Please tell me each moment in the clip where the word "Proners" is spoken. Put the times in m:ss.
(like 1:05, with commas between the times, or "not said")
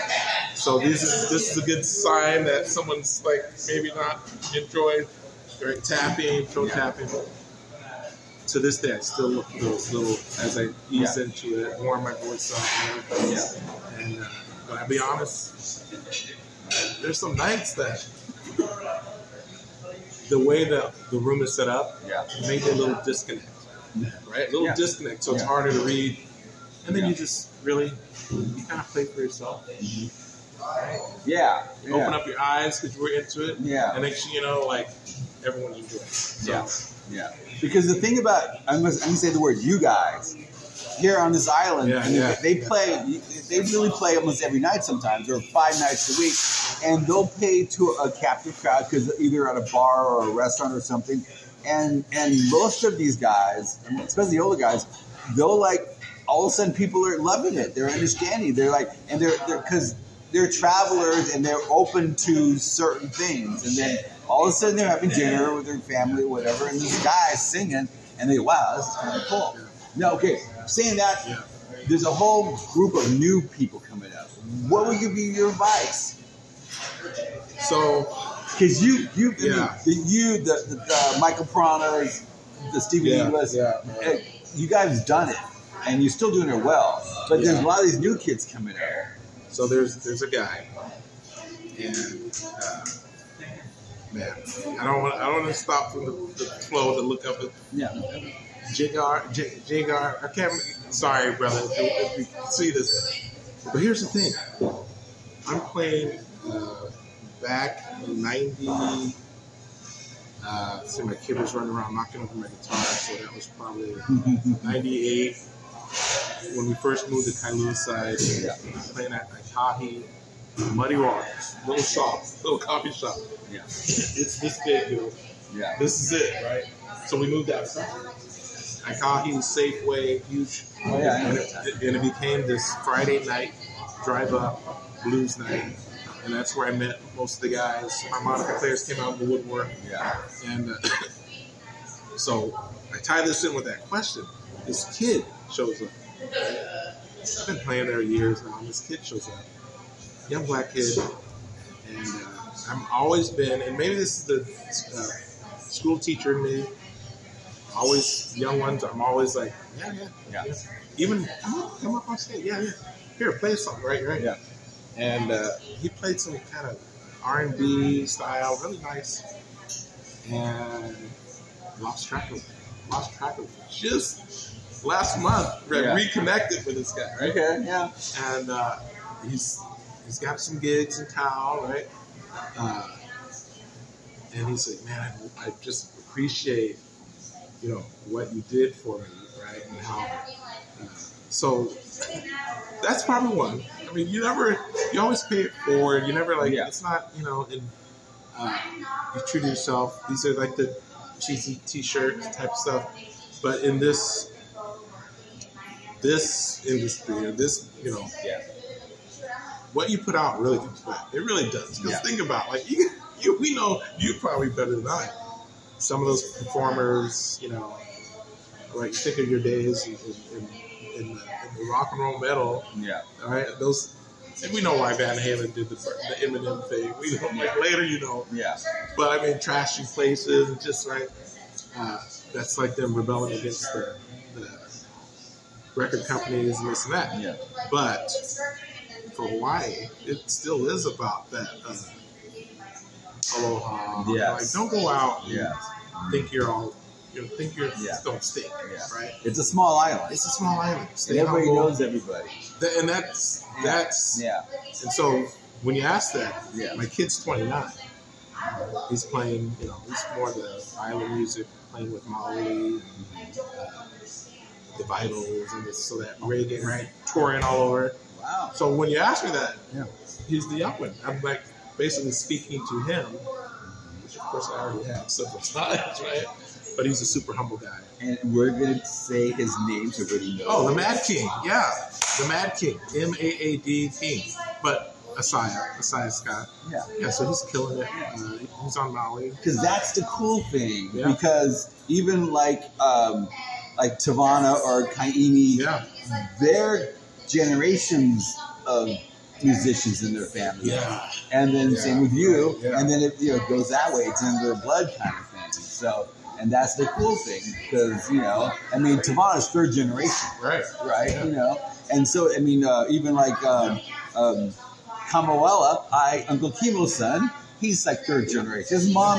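1:21.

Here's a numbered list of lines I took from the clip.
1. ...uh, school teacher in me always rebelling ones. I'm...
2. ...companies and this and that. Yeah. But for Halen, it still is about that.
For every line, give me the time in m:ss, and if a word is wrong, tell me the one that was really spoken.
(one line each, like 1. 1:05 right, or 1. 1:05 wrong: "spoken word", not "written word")
1. 2:34 wrong: "young", not "rebelling"
2. 3:56 wrong: "Hawaii", not "Halen".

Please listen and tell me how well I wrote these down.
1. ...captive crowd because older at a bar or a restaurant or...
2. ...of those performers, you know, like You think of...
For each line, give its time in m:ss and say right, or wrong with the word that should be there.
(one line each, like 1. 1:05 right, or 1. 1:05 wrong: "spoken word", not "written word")
1. 0:48 wrong: "either", not "older"
2. 3:36 right.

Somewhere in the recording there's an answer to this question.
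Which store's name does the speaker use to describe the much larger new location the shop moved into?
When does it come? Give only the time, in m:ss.
2:09.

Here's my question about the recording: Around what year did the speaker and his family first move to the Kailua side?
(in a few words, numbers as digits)
1998.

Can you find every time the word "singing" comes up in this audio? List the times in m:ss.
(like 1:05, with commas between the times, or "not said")
1:07.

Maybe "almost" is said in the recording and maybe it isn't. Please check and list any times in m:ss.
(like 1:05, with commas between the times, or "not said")
0:44.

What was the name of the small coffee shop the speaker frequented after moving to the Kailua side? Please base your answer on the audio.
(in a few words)
Muddy Waters.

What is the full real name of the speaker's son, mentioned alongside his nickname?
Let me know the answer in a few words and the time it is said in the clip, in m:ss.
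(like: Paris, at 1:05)
Asaya Scott, at 4:45.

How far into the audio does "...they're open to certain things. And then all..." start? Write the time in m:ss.
1:01.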